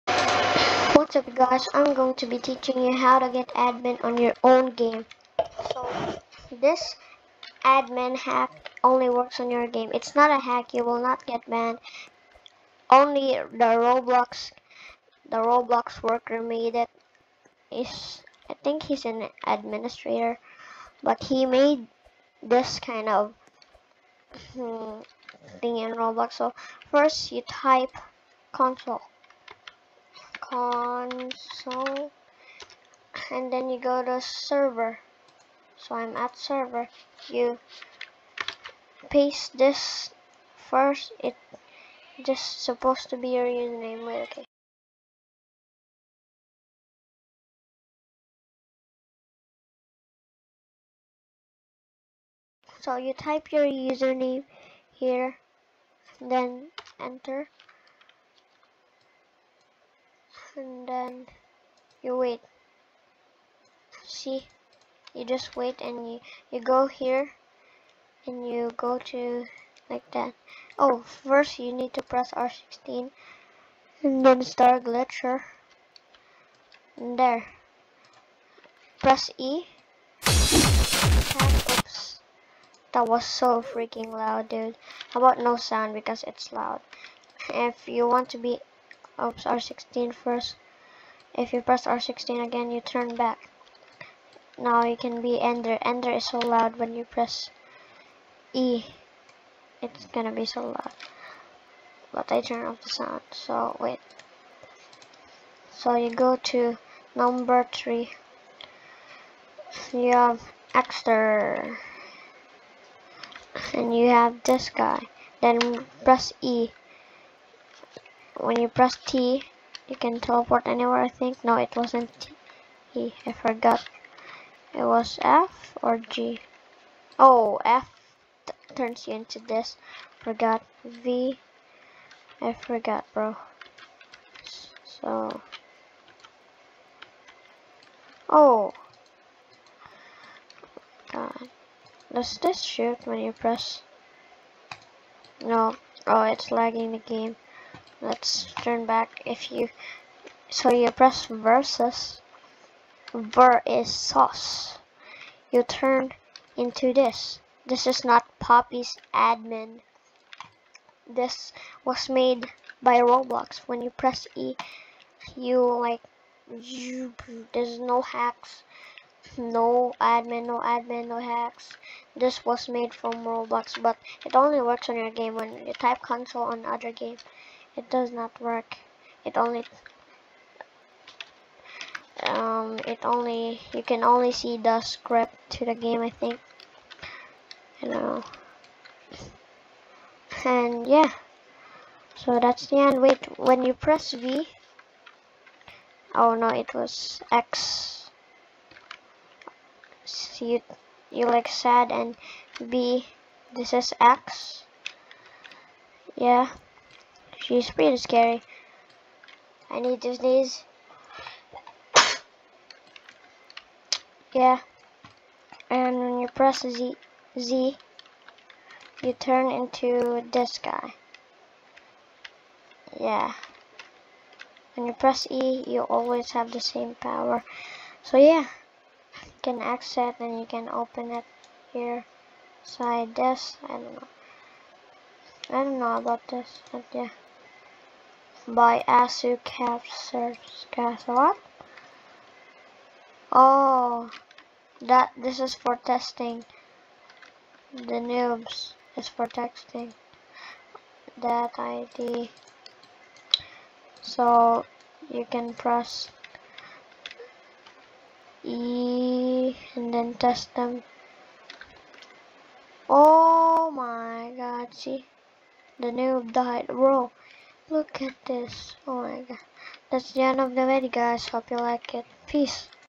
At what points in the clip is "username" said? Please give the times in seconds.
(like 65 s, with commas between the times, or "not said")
43 s, 53 s.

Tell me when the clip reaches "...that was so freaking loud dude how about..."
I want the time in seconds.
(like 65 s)
82 s.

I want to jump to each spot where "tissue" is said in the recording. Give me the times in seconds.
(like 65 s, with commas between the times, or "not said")
not said.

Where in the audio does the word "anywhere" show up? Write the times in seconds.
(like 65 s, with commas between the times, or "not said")
120 s.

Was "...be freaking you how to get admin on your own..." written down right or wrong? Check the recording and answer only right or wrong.
wrong.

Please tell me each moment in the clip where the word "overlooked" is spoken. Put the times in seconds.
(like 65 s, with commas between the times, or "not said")
not said.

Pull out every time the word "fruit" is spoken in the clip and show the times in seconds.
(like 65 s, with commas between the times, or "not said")
not said.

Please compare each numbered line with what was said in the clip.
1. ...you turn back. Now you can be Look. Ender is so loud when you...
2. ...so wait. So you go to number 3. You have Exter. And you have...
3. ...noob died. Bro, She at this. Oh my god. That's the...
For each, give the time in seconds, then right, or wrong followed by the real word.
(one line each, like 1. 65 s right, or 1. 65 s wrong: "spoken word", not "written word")
1. 92 s wrong: "Ender", not "Look"
2. 103 s right
3. 265 s wrong: "Look", not "She".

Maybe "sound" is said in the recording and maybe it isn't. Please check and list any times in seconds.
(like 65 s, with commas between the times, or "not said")
85 s, 102 s.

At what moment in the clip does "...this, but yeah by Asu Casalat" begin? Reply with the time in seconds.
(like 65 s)
236 s.